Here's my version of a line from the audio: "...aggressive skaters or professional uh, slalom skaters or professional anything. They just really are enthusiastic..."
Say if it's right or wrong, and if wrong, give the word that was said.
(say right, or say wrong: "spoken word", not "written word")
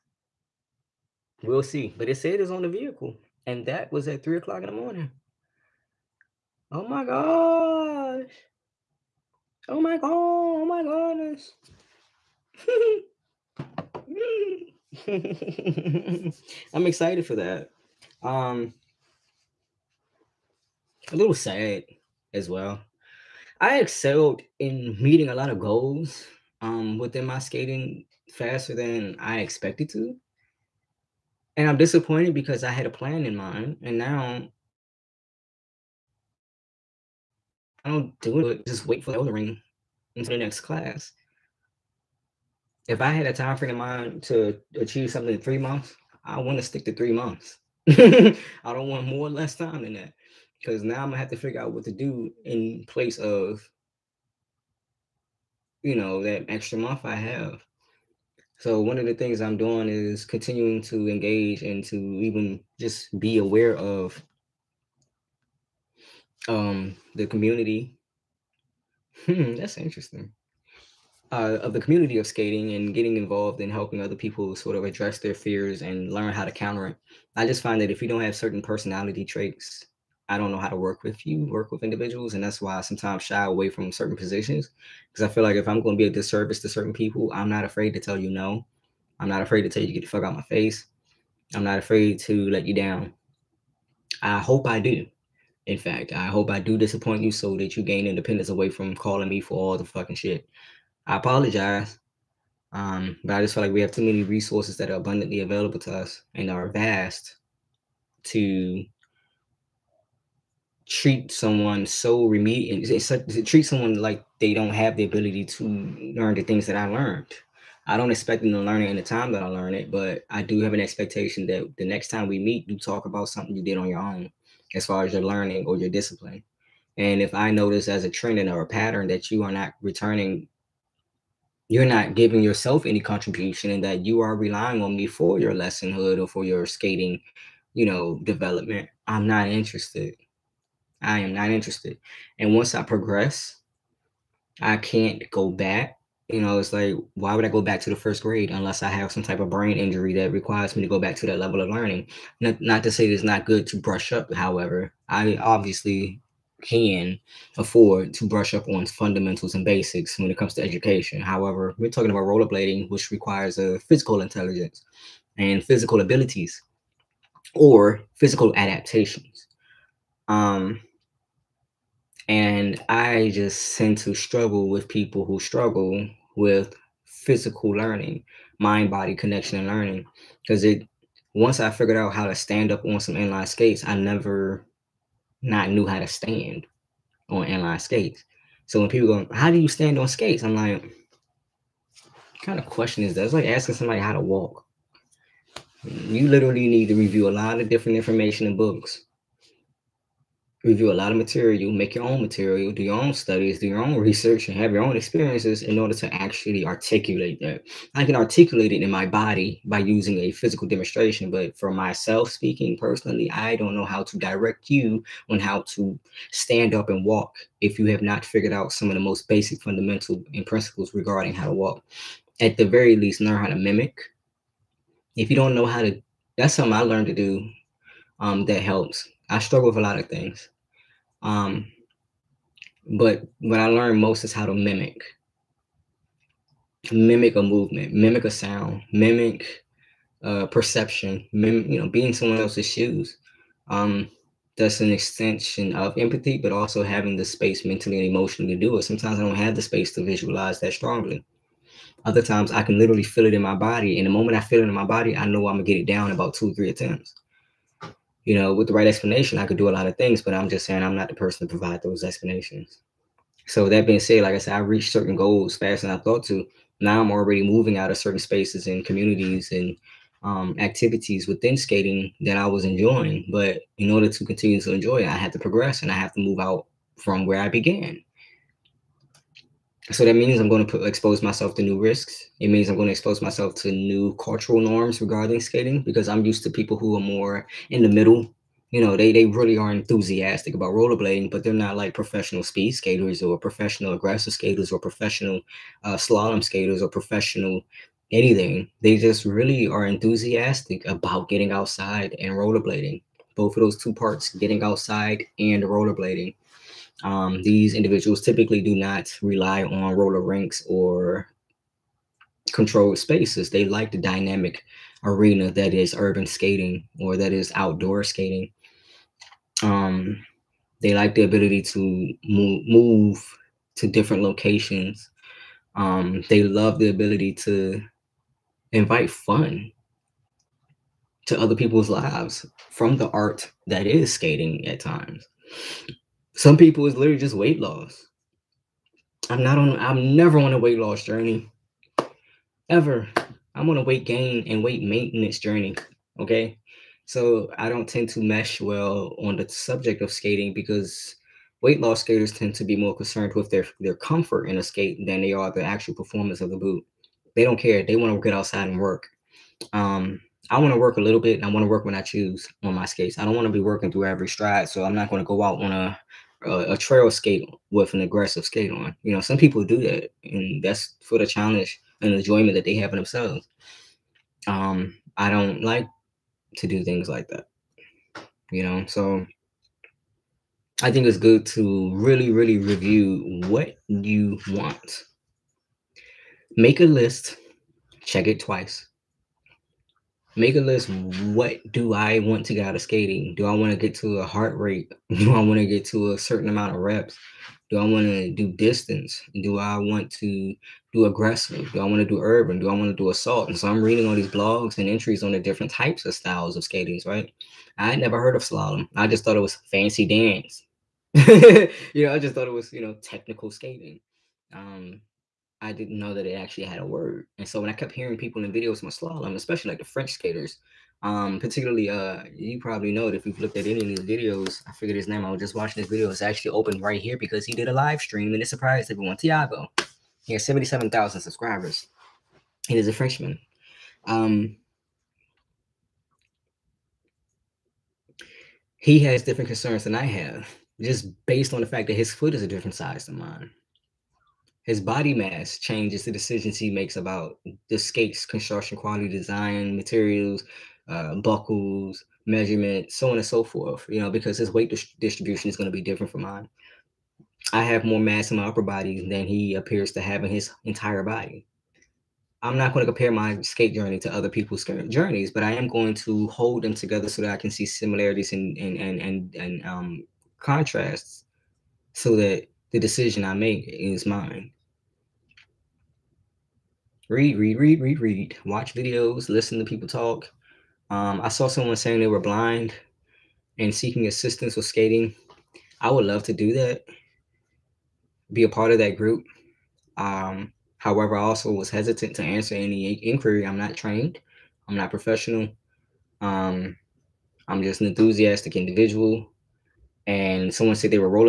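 right.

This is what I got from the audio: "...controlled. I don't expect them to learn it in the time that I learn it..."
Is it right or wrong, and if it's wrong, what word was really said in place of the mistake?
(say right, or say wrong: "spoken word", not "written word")
wrong: "learned", not "controlled".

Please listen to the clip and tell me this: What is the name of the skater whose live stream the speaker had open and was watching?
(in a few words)
Tiago.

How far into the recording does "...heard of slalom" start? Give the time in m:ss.
6:48.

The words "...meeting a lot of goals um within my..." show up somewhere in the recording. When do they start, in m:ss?
0:24.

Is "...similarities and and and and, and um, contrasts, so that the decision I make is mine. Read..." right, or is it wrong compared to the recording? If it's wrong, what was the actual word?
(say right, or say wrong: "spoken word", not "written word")
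right.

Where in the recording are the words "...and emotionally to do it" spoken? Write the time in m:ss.
4:07.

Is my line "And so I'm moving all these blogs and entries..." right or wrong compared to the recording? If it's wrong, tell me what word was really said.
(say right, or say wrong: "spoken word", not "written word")
wrong: "reading", not "moving".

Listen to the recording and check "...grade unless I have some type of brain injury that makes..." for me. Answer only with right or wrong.
wrong.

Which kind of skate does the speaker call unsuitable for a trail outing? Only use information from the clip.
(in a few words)
aggressive skate.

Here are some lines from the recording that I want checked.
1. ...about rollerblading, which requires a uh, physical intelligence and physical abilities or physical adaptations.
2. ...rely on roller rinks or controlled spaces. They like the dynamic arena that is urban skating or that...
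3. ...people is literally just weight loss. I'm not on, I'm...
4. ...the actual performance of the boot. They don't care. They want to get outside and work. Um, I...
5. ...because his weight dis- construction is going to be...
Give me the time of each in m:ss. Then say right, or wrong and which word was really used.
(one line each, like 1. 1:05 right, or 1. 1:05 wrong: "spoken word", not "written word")
1. 2:42 right
2. 5:09 right
3. 5:36 right
4. 5:55 right
5. 7:34 wrong: "distribution", not "construction".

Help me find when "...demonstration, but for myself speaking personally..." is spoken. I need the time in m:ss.
3:30.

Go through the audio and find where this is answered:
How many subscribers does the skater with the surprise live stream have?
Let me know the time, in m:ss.
7:10.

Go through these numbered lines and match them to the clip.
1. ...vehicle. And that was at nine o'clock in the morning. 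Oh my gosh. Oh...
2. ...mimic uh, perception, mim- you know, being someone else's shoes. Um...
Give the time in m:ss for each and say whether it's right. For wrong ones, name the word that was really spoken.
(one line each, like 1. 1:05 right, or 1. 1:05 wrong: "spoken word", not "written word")
1. 0:02 wrong: "three", not "nine"
2. 3:58 right.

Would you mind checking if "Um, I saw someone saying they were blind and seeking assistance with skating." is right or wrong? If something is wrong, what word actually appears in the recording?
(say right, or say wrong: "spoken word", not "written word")
right.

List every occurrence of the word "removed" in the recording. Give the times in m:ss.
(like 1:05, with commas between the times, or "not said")
not said.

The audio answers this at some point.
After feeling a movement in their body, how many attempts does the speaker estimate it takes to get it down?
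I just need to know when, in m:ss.
4:16.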